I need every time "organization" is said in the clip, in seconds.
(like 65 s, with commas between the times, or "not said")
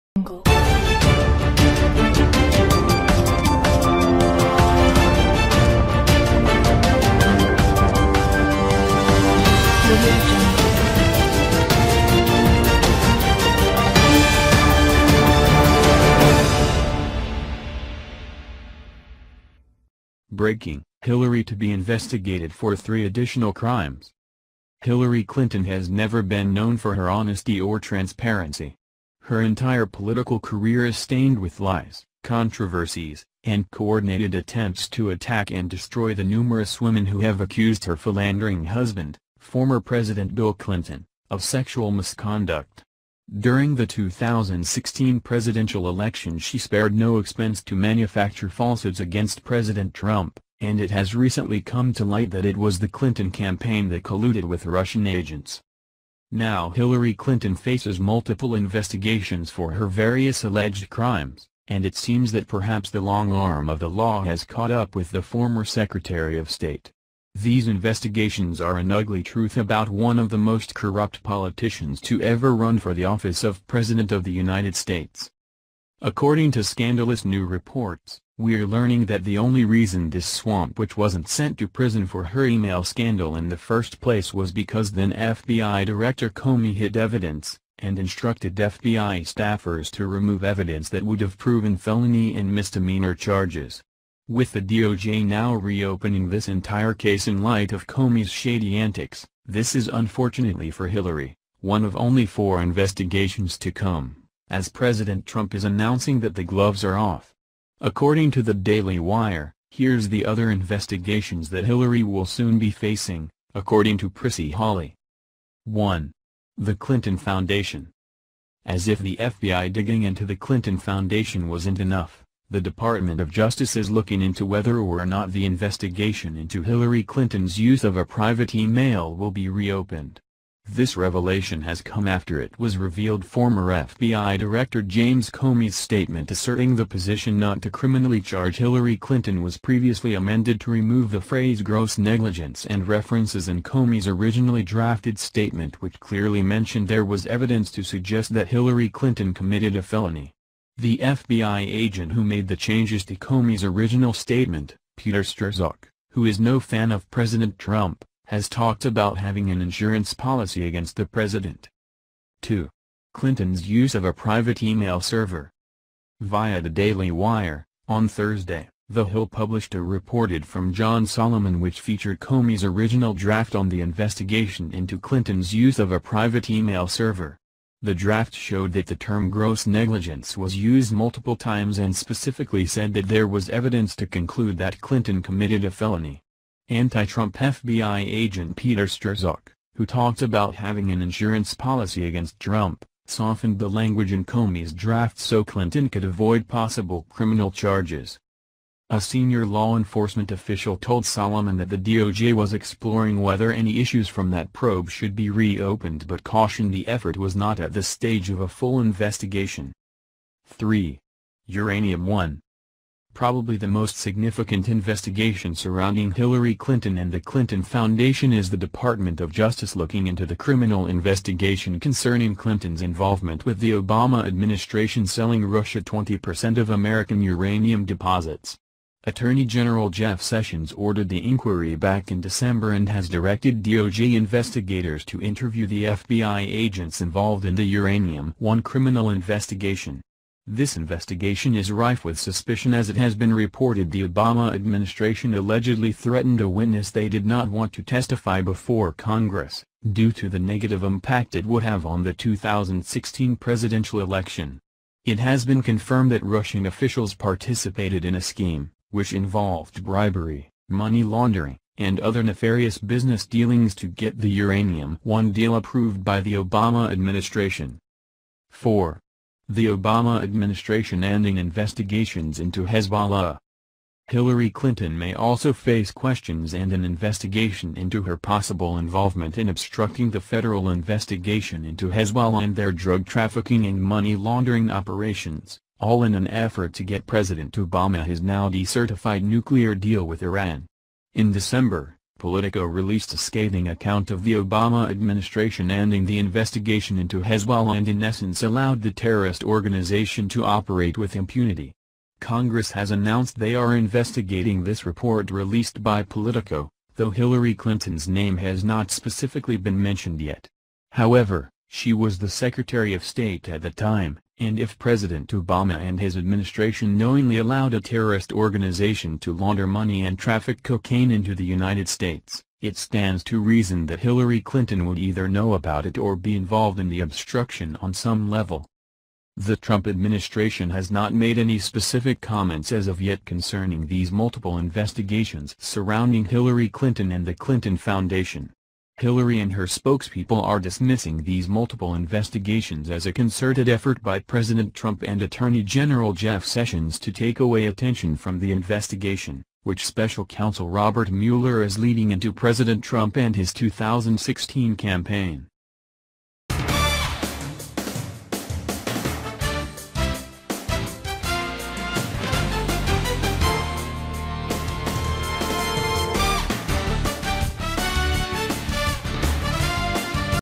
299 s, 318 s.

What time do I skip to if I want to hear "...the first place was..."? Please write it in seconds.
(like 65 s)
83 s.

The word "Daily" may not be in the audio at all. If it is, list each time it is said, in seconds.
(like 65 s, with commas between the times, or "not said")
108 s, 166 s.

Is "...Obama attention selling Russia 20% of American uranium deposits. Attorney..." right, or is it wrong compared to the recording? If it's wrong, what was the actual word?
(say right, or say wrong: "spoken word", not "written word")
wrong: "administration", not "attention".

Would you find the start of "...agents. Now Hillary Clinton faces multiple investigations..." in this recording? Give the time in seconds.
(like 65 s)
55 s.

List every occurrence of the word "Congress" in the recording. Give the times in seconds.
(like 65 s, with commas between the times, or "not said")
248 s, 302 s.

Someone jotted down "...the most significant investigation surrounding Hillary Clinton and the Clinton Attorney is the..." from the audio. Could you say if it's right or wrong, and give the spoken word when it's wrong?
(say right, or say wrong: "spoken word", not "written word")
wrong: "Foundation", not "Attorney".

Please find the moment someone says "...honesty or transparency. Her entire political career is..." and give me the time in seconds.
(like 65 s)
27 s.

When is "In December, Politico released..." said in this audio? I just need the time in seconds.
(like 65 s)
291 s.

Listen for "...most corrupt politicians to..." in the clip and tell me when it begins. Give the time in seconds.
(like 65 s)
70 s.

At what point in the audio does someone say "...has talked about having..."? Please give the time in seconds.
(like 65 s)
158 s.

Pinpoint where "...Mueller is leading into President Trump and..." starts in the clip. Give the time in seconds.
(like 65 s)
351 s.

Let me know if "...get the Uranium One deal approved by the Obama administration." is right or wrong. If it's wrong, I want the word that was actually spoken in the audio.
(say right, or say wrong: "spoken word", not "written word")
right.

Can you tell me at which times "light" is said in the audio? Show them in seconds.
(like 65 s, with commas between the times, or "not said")
52 s, 97 s.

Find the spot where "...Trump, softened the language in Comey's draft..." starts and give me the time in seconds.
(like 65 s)
192 s.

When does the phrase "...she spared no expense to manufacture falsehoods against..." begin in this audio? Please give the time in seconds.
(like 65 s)
46 s.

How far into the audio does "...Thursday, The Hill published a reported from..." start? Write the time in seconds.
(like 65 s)
168 s.